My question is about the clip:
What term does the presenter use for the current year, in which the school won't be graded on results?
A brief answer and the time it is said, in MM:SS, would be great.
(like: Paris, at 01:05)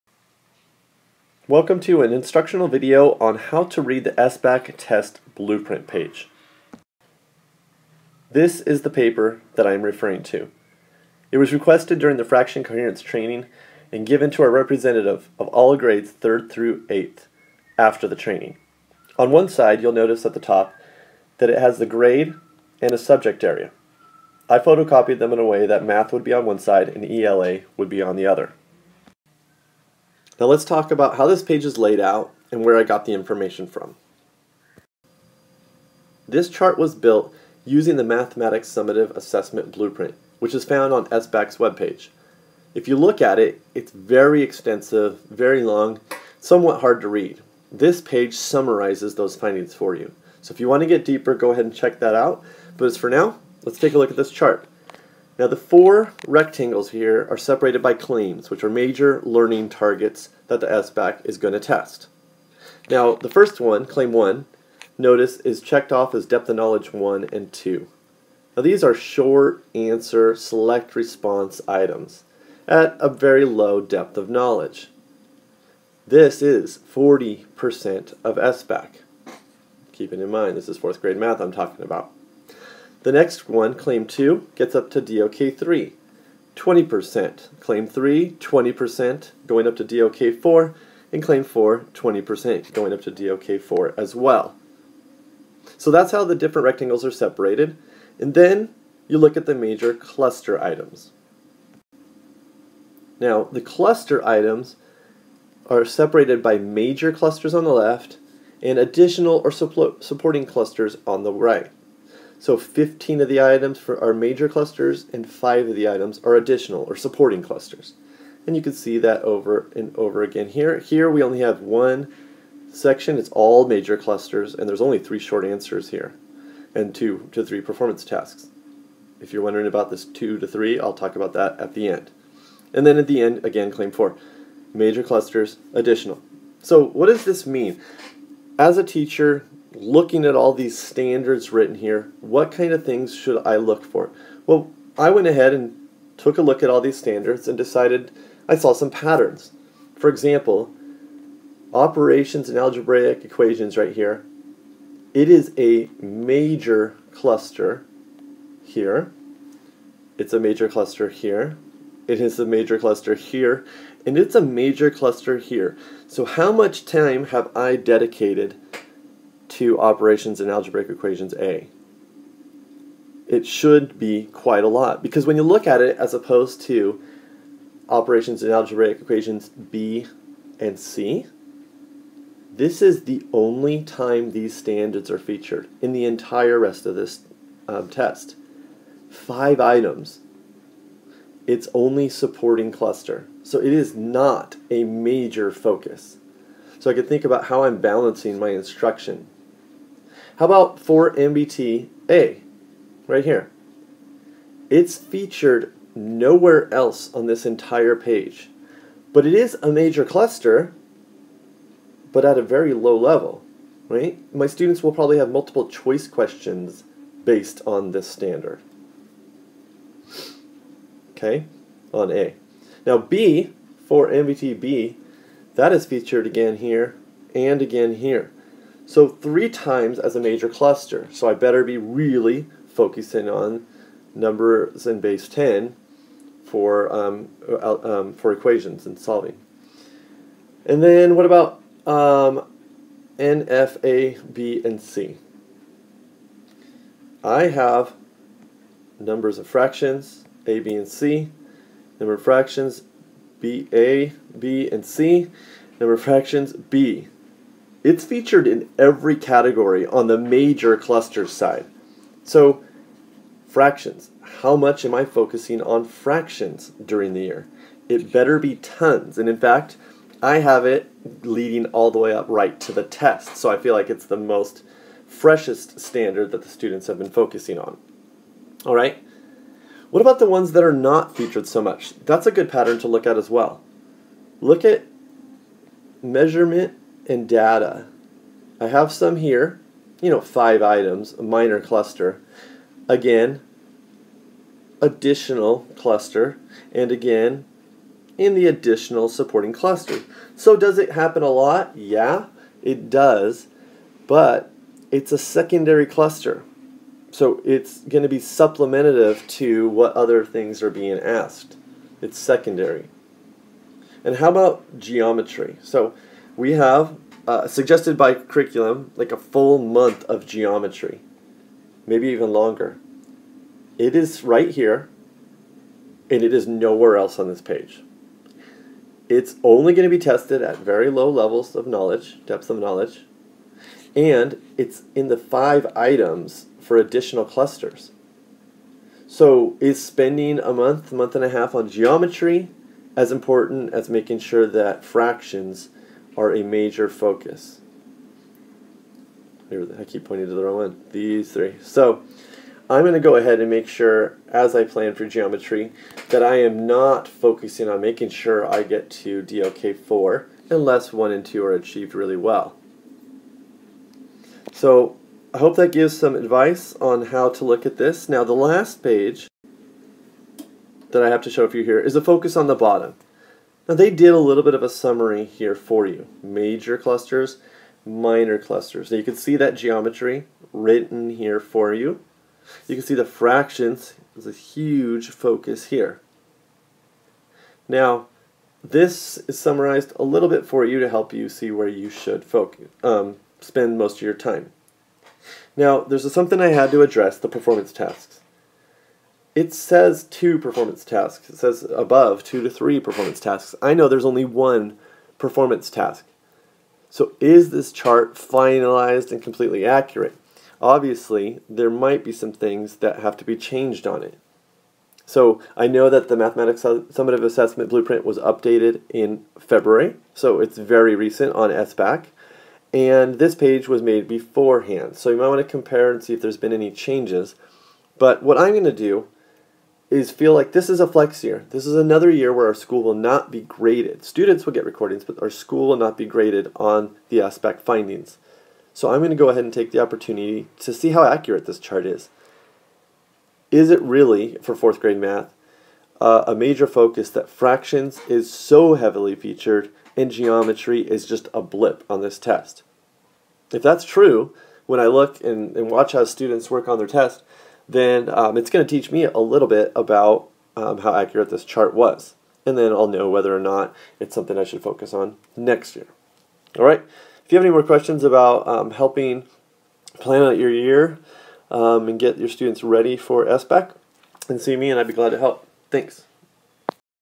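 flex year, at 07:10.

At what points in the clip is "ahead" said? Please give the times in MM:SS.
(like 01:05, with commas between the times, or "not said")
00:51, 02:25, 05:53, 07:19.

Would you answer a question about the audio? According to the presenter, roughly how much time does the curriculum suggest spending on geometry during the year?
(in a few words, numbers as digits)
a full month.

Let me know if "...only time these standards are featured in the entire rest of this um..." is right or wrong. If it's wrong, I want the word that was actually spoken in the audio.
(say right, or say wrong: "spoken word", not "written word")
right.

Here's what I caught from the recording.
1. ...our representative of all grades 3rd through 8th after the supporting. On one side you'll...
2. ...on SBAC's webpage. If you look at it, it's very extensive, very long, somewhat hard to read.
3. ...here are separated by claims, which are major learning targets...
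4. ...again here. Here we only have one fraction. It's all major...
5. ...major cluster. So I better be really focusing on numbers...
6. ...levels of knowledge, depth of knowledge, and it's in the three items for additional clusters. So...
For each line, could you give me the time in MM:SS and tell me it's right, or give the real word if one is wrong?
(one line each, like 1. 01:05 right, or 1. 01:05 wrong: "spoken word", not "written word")
1. 00:14 wrong: "training", not "supporting"
2. 00:40 right
3. 00:56 right
4. 02:00 wrong: "section", not "fraction"
5. 03:50 right
6. 05:31 wrong: "five", not "three".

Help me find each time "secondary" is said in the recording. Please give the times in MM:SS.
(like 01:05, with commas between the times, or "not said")
05:05, 05:12.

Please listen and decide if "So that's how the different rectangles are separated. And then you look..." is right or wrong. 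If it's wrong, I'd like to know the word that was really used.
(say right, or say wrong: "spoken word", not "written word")
right.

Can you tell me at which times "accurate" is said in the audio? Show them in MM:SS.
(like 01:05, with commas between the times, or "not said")
06:49, 07:21, 07:40.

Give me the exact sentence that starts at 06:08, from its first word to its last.
Now the last page that I have to show for you here is a focus on the bottom.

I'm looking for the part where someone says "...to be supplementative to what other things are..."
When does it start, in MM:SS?
05:08.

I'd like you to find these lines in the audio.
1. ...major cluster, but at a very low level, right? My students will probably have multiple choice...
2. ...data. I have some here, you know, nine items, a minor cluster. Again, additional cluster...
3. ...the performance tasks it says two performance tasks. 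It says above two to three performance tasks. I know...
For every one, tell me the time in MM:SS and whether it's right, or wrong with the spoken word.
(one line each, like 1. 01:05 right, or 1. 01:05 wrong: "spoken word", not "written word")
1. 03:29 right
2. 04:47 wrong: "five", not "nine"
3. 06:37 right.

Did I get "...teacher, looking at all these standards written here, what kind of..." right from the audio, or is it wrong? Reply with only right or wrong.
right.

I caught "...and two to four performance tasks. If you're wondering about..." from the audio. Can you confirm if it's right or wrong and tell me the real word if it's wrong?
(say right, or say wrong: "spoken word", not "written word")
wrong: "three", not "four".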